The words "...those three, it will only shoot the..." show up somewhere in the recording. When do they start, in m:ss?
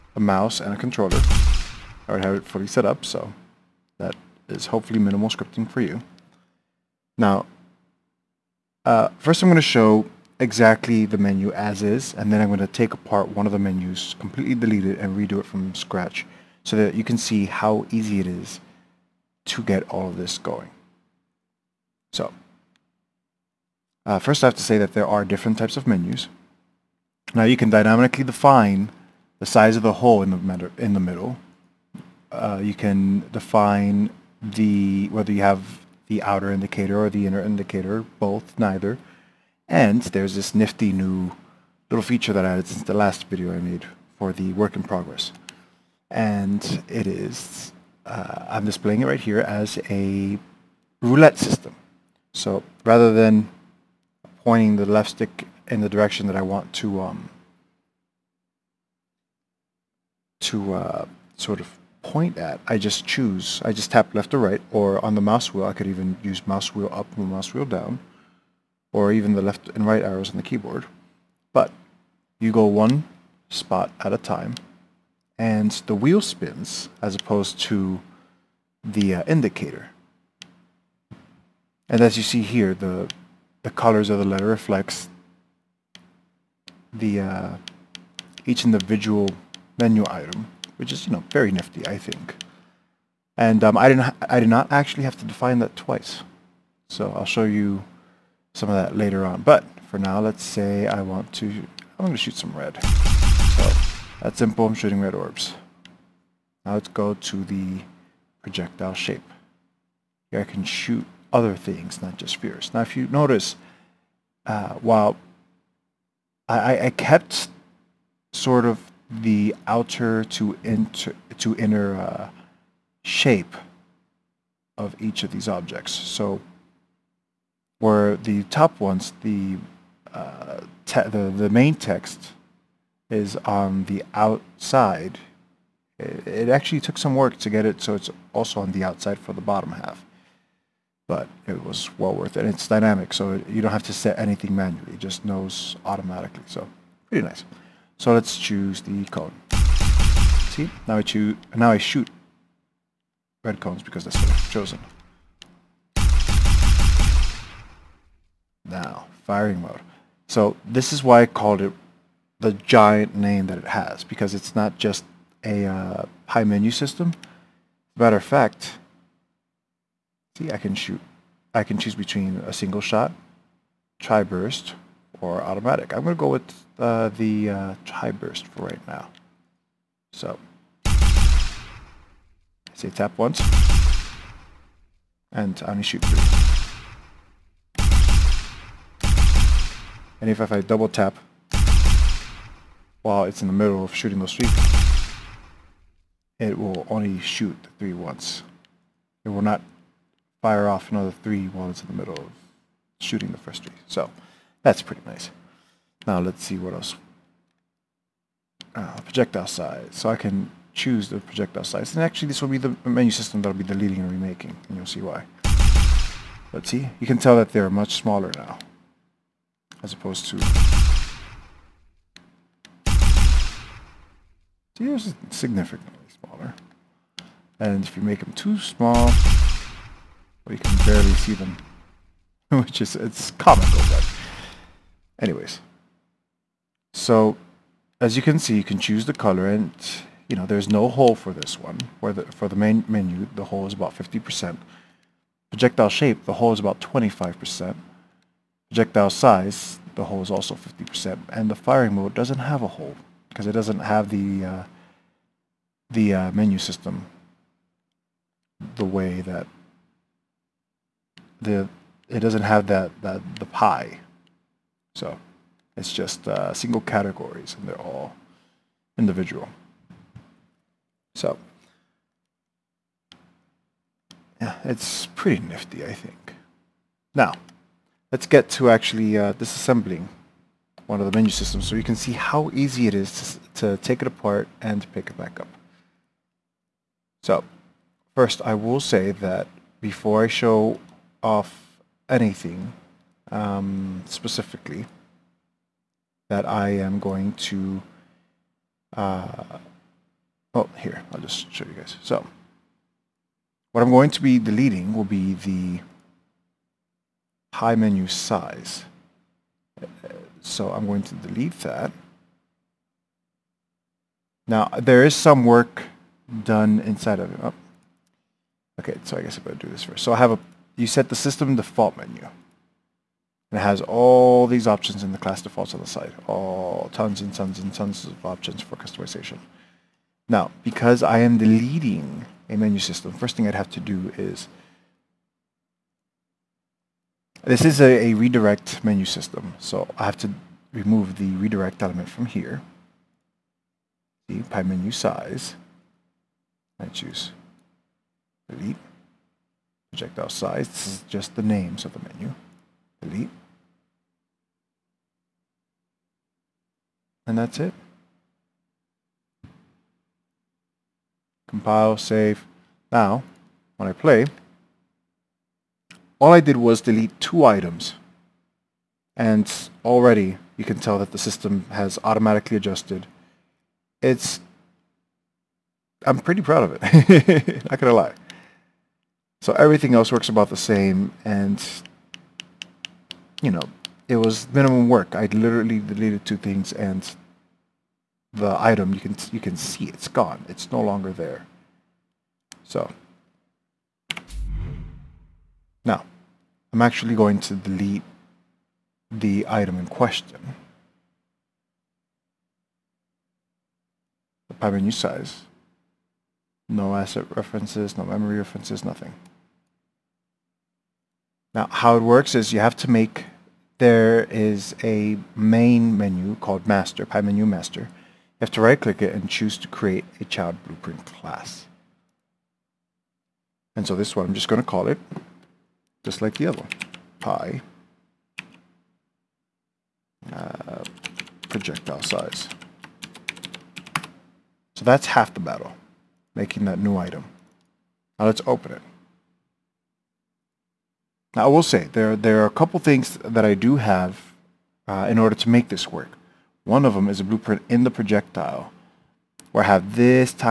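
3:14.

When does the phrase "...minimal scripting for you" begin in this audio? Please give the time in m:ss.
0:04.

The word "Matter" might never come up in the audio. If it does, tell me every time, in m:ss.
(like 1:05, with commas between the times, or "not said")
2:47.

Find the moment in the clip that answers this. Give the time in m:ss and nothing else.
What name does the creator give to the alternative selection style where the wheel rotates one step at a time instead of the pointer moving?
0:51.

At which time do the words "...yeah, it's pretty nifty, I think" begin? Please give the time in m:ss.
4:34.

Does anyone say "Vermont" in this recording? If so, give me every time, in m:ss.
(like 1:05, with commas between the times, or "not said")
not said.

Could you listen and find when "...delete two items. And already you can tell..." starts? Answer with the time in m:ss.
6:06.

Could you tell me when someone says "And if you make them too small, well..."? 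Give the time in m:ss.
3:47.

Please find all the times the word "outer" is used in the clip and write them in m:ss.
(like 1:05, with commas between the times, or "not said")
0:36, 1:59.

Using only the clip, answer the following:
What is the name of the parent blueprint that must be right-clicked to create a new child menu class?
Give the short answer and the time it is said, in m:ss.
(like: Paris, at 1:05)
Menu Master, at 6:57.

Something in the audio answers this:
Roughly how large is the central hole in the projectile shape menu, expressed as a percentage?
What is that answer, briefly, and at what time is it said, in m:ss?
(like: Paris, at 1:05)
25%, at 4:06.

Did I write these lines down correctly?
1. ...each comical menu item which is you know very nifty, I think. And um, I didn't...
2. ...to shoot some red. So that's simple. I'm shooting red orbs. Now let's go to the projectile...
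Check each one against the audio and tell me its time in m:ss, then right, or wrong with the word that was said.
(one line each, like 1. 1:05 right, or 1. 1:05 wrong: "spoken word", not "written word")
1. 1:28 wrong: "individual", not "comical"
2. 1:42 right.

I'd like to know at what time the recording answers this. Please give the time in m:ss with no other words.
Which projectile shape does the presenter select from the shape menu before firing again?
2:29.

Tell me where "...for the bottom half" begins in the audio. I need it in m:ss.
2:19.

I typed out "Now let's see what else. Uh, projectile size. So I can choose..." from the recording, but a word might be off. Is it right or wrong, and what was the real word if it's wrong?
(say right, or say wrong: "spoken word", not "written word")
right.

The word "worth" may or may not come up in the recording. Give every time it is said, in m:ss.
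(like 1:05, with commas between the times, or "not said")
2:22.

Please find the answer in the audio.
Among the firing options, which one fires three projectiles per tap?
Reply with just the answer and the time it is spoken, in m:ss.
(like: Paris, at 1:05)
Tri burst, at 2:53.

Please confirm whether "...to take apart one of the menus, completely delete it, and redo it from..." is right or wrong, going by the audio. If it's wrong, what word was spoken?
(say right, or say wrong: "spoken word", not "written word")
right.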